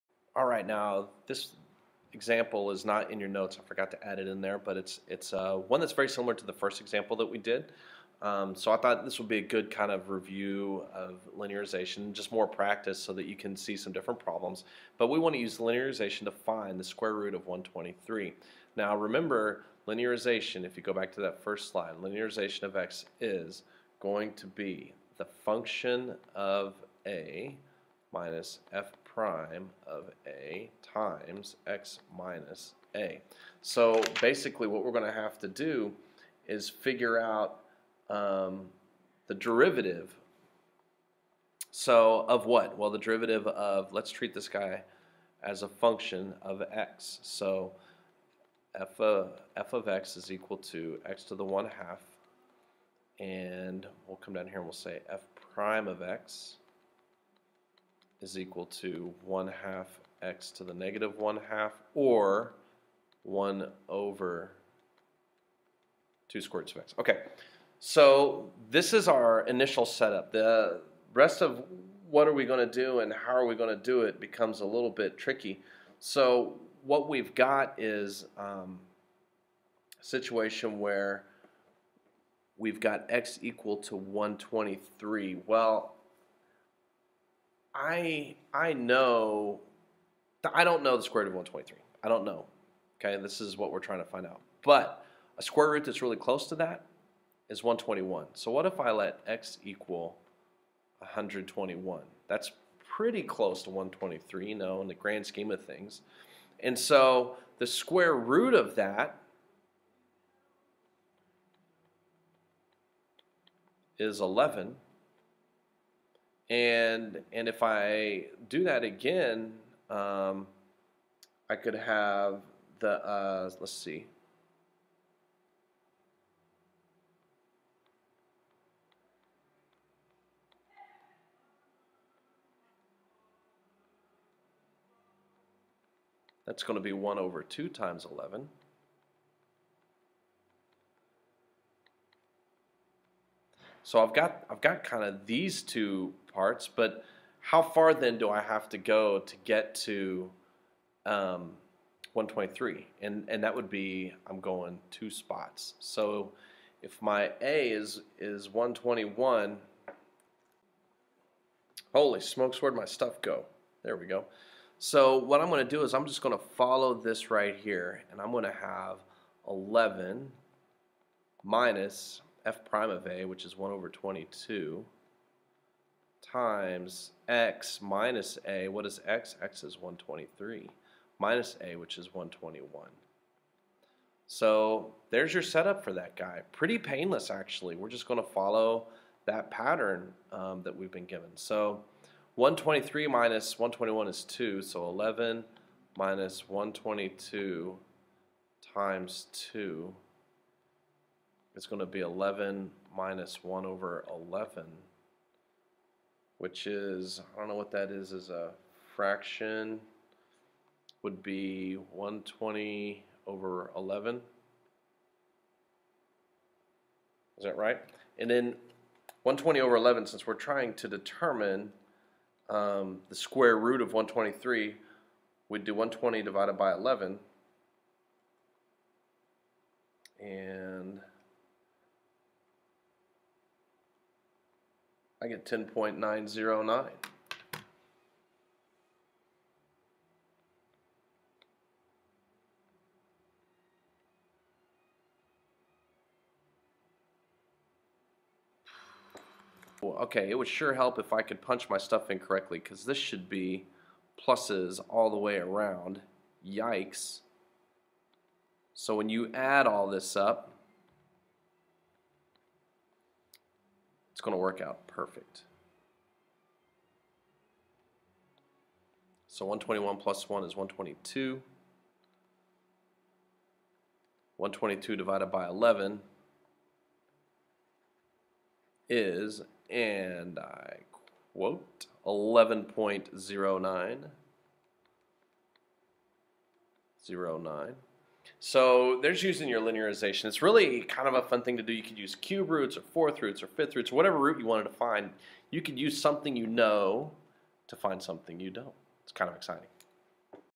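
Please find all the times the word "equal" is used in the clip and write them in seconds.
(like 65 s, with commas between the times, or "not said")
50 s, 58 s, 83 s, 99 s.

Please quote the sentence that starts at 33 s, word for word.
So basically what we're going to have to do is figure out um, the derivative.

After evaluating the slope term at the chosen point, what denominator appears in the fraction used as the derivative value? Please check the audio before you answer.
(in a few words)
22.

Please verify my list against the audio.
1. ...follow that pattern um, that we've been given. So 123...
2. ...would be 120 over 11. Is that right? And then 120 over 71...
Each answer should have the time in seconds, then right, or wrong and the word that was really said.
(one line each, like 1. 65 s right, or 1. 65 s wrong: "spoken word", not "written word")
1. 188 s right
2. 211 s wrong: "11", not "71".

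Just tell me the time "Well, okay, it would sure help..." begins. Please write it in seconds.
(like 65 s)
249 s.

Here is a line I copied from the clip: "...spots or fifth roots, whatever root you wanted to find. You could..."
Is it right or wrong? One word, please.
wrong.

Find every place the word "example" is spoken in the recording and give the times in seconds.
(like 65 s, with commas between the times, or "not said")
2 s, 6 s.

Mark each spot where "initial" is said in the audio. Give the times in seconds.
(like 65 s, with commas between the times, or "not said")
69 s.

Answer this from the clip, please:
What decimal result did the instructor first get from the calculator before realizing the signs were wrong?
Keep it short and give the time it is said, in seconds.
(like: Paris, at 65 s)
10.909, at 235 s.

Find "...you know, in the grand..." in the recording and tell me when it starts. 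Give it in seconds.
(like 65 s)
104 s.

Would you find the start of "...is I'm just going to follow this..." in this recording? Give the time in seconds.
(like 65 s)
165 s.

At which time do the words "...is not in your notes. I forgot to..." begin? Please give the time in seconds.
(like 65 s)
2 s.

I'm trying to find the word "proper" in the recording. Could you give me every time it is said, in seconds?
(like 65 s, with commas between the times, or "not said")
not said.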